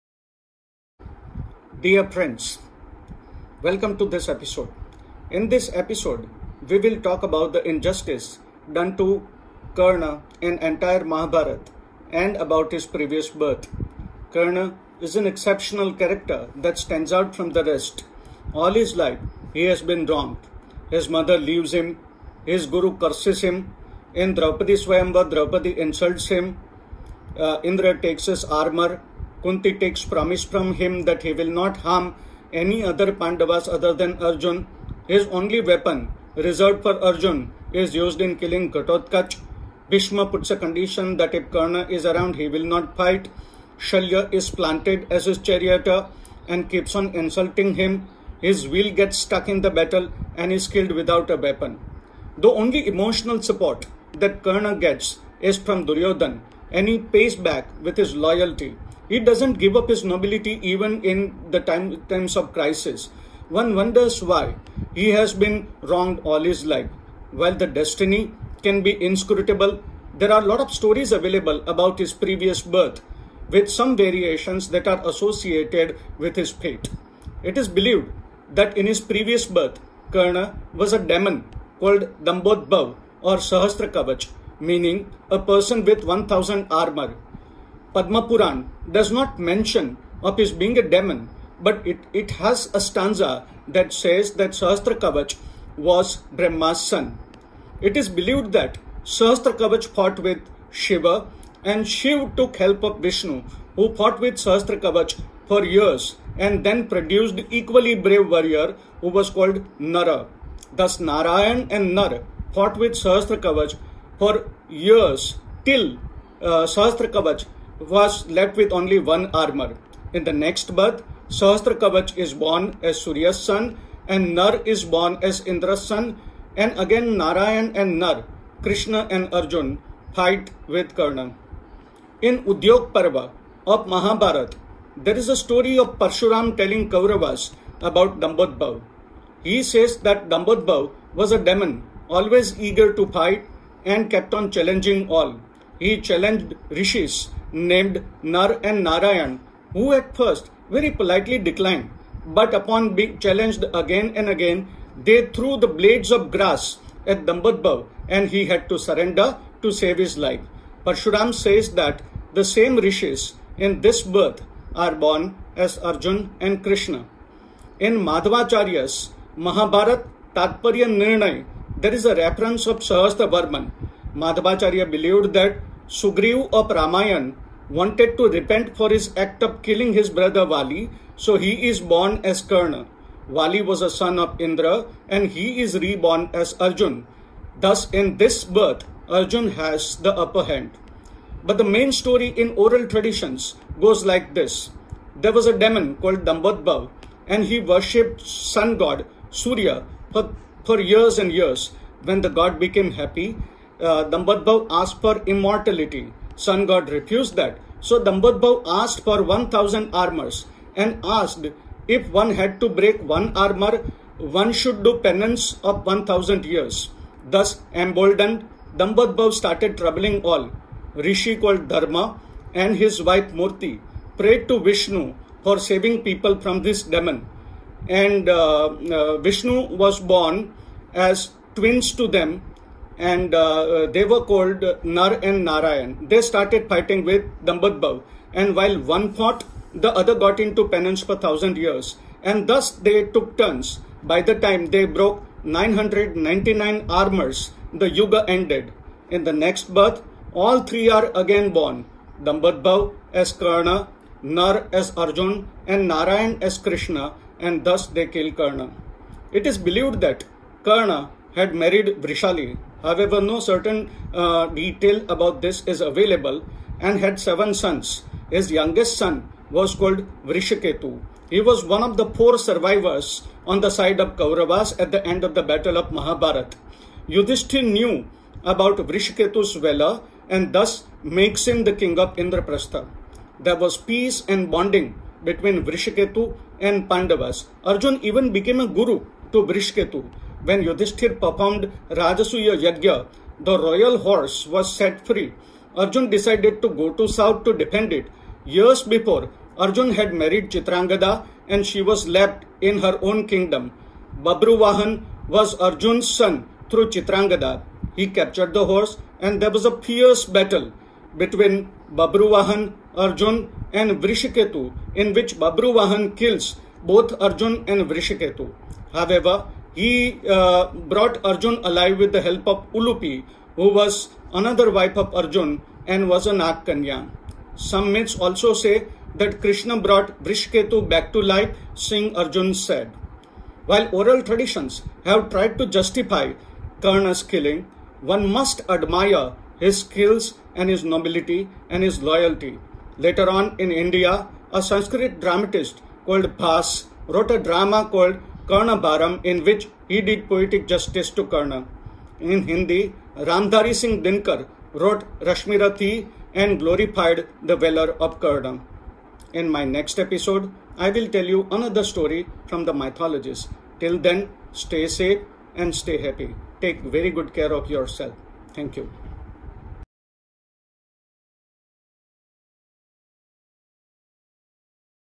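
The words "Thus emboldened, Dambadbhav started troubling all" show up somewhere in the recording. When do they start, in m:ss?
3:37.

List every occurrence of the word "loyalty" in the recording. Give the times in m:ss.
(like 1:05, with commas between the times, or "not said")
0:58, 5:42.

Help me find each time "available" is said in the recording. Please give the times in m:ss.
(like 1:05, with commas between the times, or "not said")
1:11, 4:25.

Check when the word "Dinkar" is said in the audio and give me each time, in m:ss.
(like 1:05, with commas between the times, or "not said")
5:54.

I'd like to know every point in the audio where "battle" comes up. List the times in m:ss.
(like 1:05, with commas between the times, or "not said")
0:49, 4:35, 5:10.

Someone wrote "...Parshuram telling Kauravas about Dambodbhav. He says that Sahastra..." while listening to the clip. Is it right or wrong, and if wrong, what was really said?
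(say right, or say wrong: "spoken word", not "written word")
wrong: "Dambodbhav", not "Sahastra".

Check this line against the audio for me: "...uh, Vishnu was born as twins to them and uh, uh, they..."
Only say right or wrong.
right.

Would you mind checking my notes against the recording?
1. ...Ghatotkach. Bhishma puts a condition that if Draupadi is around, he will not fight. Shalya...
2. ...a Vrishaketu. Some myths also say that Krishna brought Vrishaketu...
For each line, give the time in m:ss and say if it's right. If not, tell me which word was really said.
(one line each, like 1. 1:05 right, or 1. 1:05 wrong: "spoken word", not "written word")
1. 0:38 wrong: "Karna", not "Draupadi"
2. 5:26 wrong: "Nagkanya", not "Vrishaketu".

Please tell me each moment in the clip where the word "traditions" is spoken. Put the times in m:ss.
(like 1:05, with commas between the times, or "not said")
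3:12, 5:34.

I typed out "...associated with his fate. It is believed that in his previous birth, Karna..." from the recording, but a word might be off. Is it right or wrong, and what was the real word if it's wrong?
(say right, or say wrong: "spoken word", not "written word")
right.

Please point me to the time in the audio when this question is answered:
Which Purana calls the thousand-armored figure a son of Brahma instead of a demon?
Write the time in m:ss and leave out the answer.
1:27.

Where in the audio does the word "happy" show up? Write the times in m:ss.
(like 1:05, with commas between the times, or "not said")
3:22, 6:06.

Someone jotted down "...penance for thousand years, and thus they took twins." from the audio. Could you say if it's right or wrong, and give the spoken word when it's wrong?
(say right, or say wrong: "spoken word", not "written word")
wrong: "turns", not "twins".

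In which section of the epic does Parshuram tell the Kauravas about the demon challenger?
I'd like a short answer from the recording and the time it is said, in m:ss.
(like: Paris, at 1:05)
Udyog Parva, at 2:12.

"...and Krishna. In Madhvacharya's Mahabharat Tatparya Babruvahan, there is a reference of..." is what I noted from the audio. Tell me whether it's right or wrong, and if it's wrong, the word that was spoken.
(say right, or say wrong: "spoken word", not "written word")
wrong: "Nirnay", not "Babruvahan".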